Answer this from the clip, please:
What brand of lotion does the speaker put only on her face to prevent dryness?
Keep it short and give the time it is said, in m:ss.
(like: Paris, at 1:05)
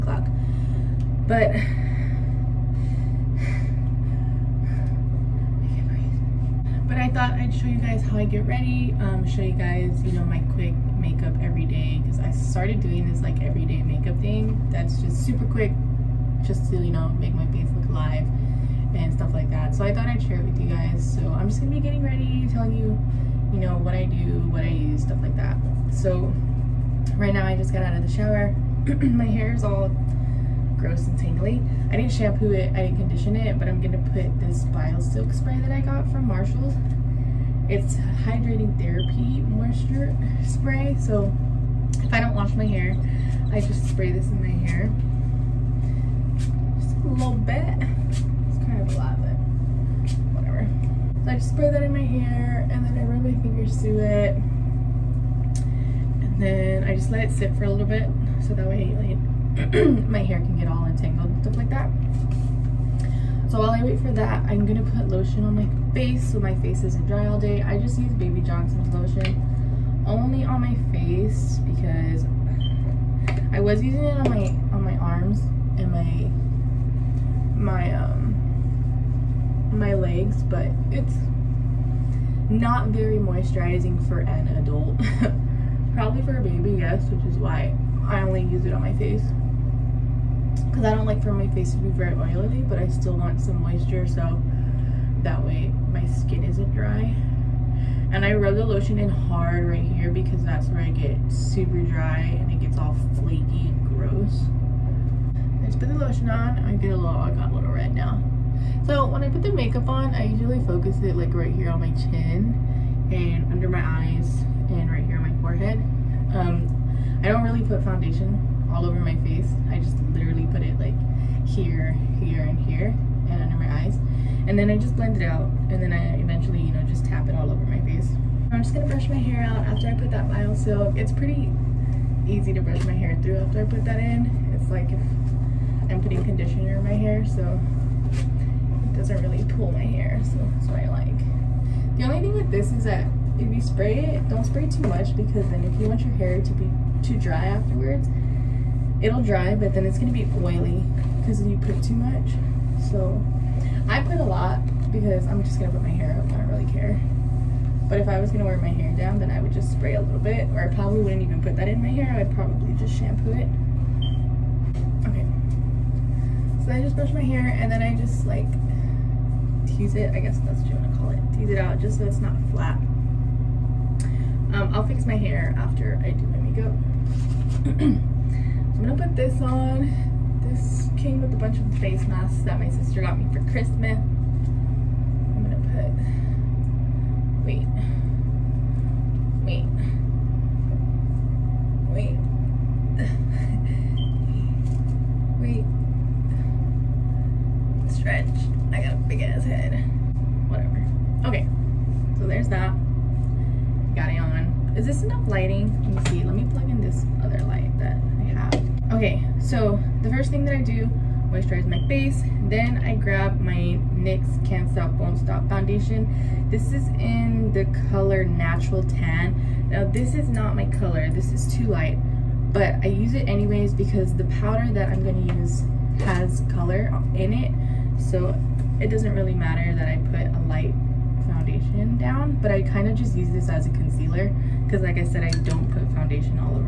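Baby Johnson's, at 1:08.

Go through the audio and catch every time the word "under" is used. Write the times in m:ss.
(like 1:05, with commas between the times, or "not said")
1:53, 2:03.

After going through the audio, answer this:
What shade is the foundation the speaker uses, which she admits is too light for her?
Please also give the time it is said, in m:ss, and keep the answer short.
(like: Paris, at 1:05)
Natural Tan, at 3:38.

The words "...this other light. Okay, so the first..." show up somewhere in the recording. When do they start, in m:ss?
3:26.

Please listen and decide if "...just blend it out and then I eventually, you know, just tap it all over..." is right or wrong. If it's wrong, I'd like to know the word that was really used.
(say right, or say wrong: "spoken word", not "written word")
right.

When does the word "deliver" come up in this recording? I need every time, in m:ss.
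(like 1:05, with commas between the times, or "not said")
not said.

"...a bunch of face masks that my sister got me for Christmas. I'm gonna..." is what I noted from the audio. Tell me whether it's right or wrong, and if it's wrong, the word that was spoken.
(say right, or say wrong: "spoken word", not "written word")
right.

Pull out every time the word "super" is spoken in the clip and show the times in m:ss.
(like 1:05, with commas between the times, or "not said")
0:15, 1:41.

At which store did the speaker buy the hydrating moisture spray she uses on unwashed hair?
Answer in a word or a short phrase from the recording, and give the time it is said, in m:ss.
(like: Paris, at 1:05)
Marshall's, at 0:36.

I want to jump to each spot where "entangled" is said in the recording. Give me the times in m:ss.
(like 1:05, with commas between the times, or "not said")
1:00.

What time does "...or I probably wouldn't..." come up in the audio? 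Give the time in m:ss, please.
2:40.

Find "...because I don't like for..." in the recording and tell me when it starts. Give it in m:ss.
1:30.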